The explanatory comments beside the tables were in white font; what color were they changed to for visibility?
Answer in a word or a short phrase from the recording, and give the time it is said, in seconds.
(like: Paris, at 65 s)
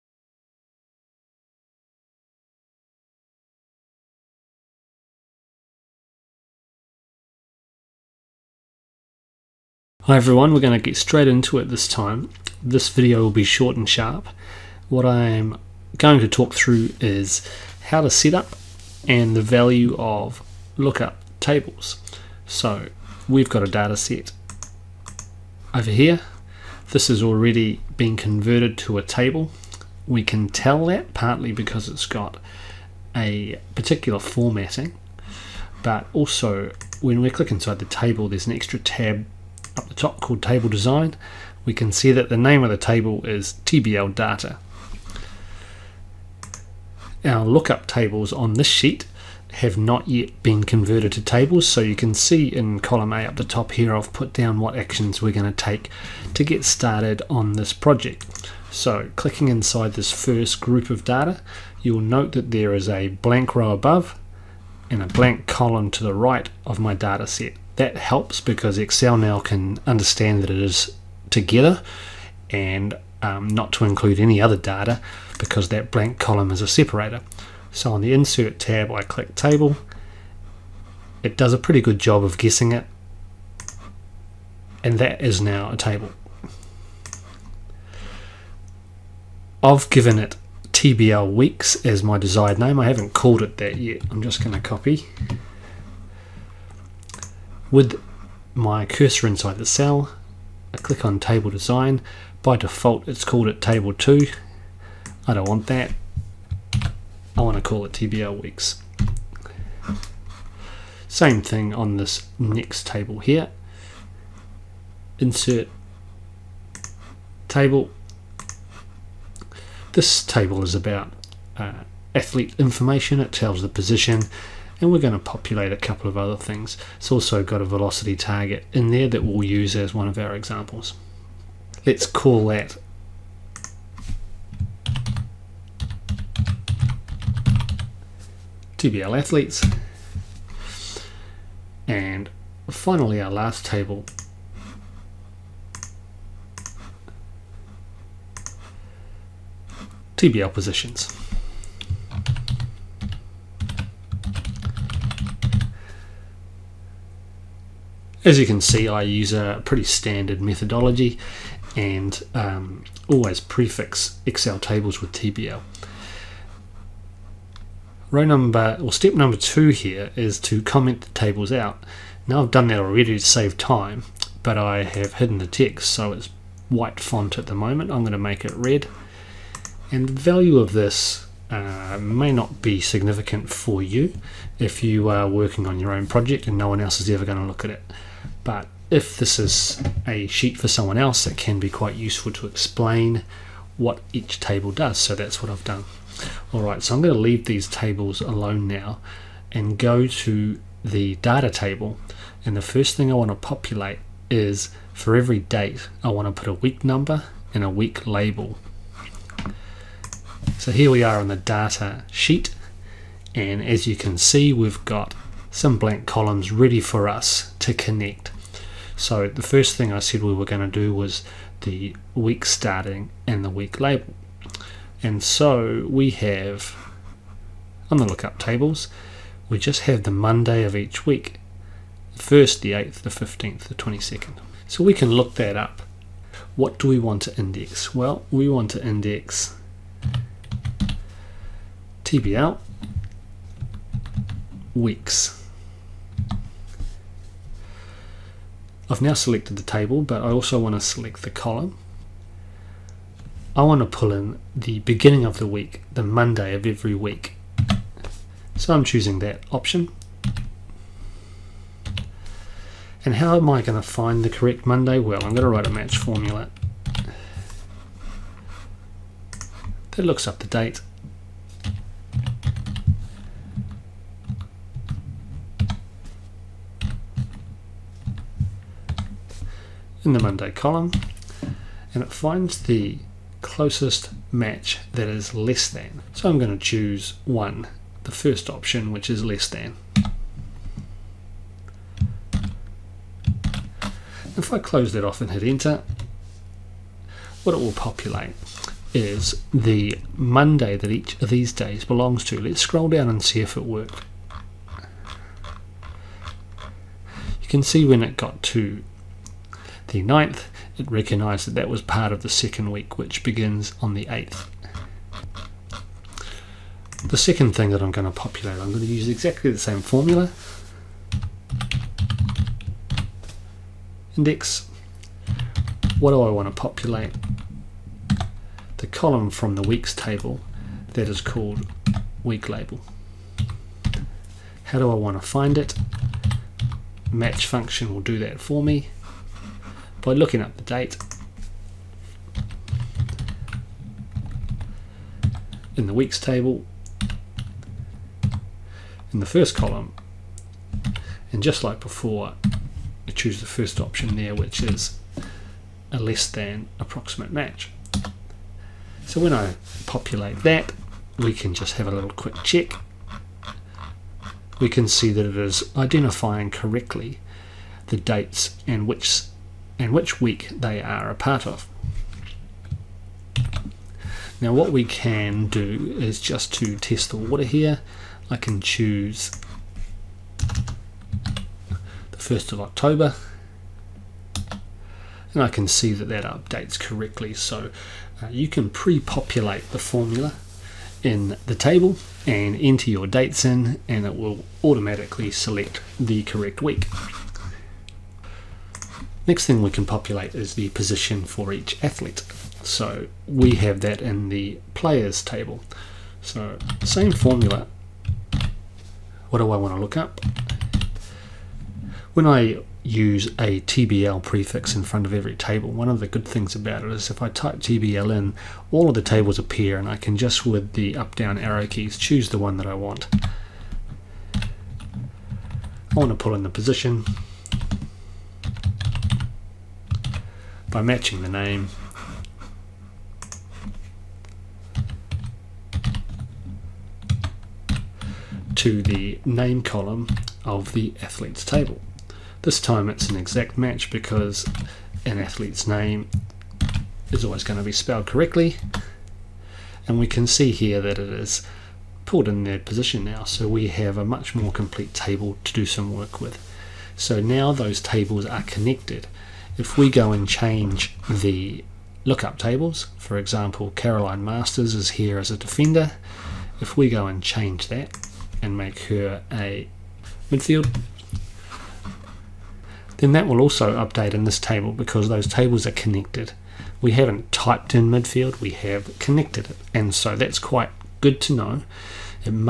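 Red, at 178 s.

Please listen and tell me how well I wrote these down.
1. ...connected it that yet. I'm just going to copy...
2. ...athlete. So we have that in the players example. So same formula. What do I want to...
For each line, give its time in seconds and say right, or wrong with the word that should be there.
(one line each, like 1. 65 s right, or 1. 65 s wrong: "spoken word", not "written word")
1. 93 s wrong: "called", not "connected"
2. 401 s wrong: "table", not "example".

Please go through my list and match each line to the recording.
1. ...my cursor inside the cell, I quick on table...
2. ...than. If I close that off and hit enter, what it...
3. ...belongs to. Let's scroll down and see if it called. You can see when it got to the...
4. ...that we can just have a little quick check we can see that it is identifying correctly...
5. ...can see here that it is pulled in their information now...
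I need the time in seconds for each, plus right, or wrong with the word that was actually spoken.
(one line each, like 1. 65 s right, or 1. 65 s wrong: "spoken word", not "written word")
1. 98 s wrong: "click", not "quick"
2. 289 s right
3. 301 s wrong: "worked", not "called"
4. 360 s right
5. 450 s wrong: "position", not "information".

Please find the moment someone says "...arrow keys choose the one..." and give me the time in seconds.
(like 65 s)
421 s.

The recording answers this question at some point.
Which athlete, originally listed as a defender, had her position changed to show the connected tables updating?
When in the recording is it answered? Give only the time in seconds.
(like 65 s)
463 s.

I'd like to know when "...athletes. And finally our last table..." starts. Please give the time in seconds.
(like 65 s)
139 s.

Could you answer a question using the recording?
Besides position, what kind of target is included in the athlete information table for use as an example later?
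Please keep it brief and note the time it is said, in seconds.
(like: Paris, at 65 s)
Velocity target, at 127 s.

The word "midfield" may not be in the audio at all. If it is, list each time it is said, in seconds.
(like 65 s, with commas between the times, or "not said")
470 s, 477 s.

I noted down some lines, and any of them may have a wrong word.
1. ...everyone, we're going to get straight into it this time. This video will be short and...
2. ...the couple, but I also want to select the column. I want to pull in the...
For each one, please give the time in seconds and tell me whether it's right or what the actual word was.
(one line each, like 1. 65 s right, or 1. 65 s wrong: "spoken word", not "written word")
1. 10 s right
2. 249 s wrong: "table", not "couple".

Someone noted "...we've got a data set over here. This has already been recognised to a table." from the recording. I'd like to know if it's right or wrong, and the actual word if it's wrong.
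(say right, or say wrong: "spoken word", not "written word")
wrong: "converted", not "recognised".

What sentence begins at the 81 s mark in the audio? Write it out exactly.
It does a pretty good job of guessing it and that is now a table.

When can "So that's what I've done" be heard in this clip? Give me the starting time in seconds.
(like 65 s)
194 s.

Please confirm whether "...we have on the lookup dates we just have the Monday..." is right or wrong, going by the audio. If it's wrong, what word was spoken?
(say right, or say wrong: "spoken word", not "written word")
wrong: "tables", not "dates".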